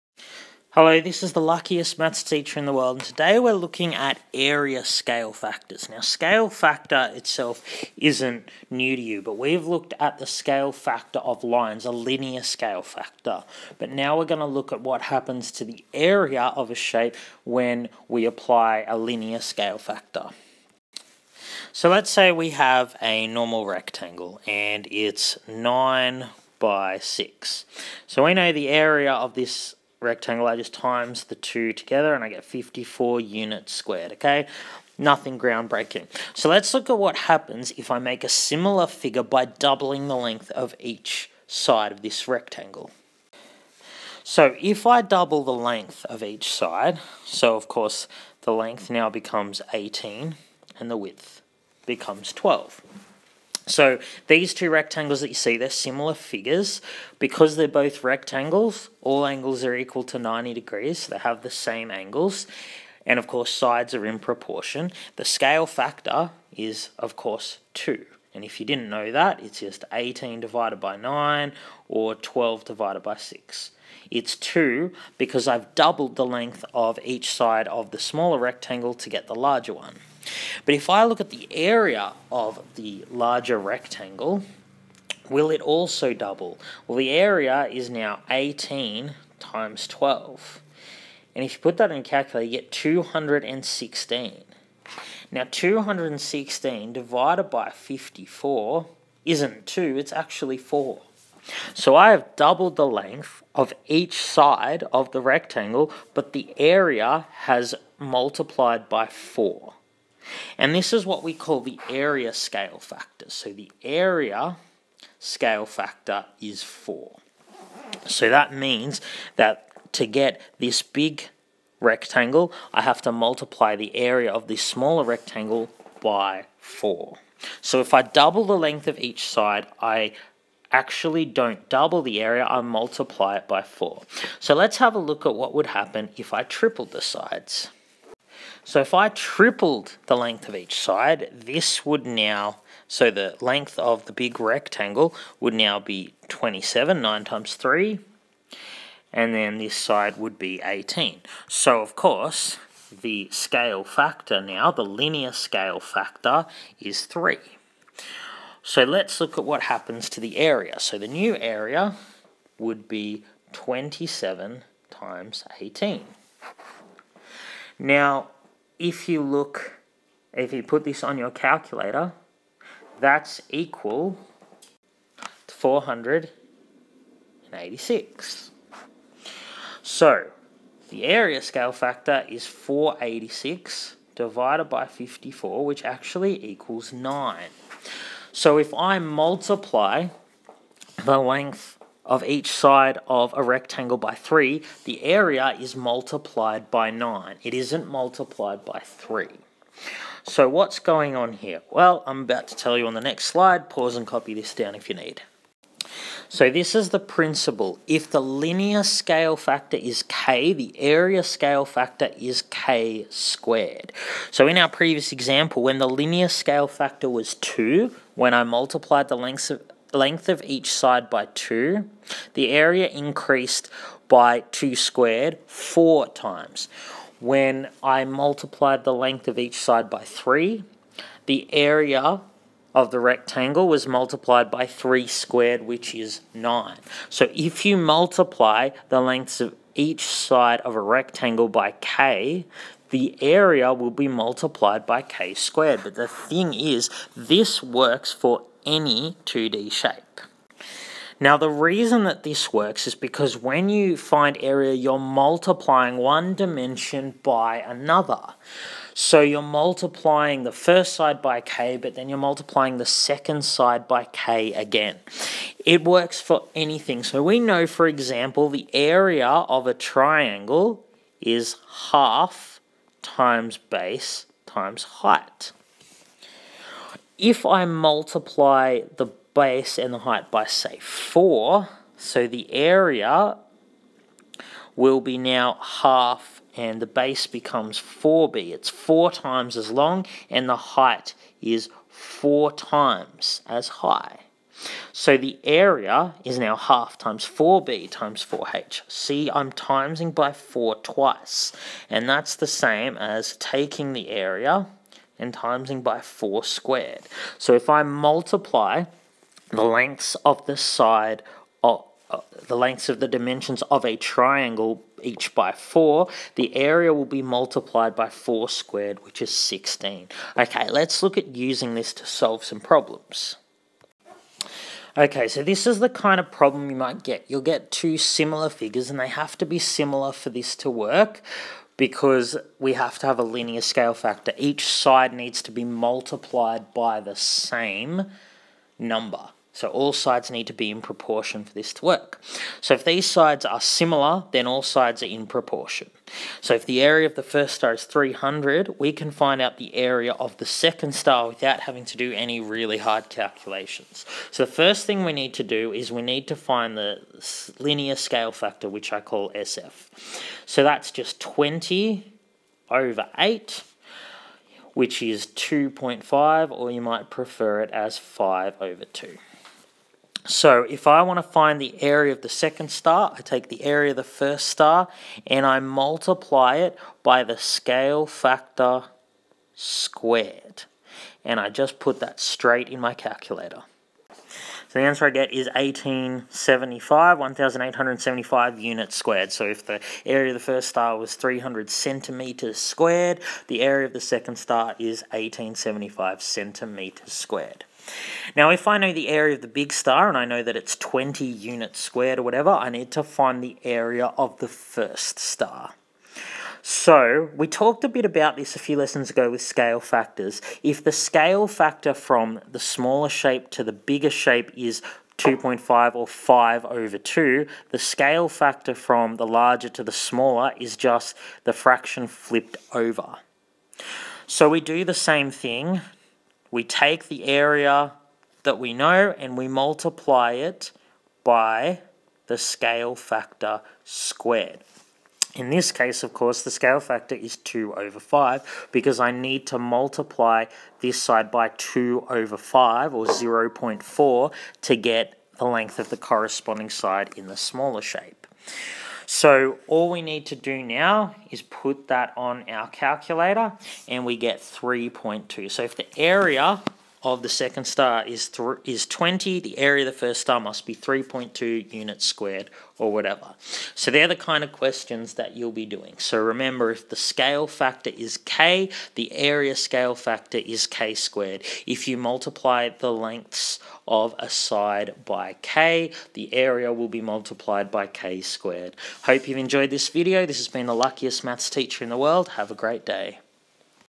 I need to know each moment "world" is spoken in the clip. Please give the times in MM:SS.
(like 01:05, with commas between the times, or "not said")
00:02, 08:01.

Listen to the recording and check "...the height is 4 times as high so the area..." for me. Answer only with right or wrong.
right.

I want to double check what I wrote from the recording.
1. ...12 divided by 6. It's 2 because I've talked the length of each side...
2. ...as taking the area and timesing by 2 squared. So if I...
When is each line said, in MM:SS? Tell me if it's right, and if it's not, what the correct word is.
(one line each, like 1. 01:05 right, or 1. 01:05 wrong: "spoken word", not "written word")
1. 01:12 wrong: "doubled", not "talked"
2. 05:02 wrong: "4", not "2".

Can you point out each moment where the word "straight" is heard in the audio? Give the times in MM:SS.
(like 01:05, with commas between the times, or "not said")
06:22.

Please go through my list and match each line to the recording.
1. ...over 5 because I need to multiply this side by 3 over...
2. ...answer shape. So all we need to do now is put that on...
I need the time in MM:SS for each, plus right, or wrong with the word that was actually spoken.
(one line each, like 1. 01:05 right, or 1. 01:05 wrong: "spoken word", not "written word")
1. 07:17 wrong: "2", not "3"
2. 07:27 wrong: "smaller", not "answer".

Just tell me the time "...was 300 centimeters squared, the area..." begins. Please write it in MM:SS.
06:30.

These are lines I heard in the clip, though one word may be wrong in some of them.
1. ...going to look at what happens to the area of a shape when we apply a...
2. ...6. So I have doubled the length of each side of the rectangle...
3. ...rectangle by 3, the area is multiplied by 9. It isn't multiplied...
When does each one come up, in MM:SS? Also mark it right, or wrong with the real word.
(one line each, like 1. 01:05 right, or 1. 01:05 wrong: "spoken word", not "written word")
1. 00:14 right
2. 01:40 wrong: "4", not "6"
3. 03:13 right.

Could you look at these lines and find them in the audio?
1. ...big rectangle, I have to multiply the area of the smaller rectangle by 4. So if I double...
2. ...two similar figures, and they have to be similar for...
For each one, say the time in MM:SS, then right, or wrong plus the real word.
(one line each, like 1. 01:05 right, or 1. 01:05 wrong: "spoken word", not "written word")
1. 02:00 right
2. 05:27 right.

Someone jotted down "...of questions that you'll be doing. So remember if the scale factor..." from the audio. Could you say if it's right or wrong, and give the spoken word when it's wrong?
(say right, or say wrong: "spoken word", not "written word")
right.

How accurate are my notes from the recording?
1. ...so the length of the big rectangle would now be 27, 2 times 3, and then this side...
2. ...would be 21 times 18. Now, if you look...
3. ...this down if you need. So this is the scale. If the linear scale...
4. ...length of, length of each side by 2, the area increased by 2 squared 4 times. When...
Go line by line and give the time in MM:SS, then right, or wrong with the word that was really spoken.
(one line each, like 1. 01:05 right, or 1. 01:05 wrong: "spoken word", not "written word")
1. 02:22 wrong: "9", not "2"
2. 02:42 wrong: "27", not "21"
3. 03:24 wrong: "principle", not "scale"
4. 03:39 right.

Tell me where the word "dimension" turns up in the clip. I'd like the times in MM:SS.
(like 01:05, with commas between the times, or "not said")
04:16, 05:13.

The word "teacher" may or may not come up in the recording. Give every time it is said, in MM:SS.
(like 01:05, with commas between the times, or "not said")
00:02, 08:01.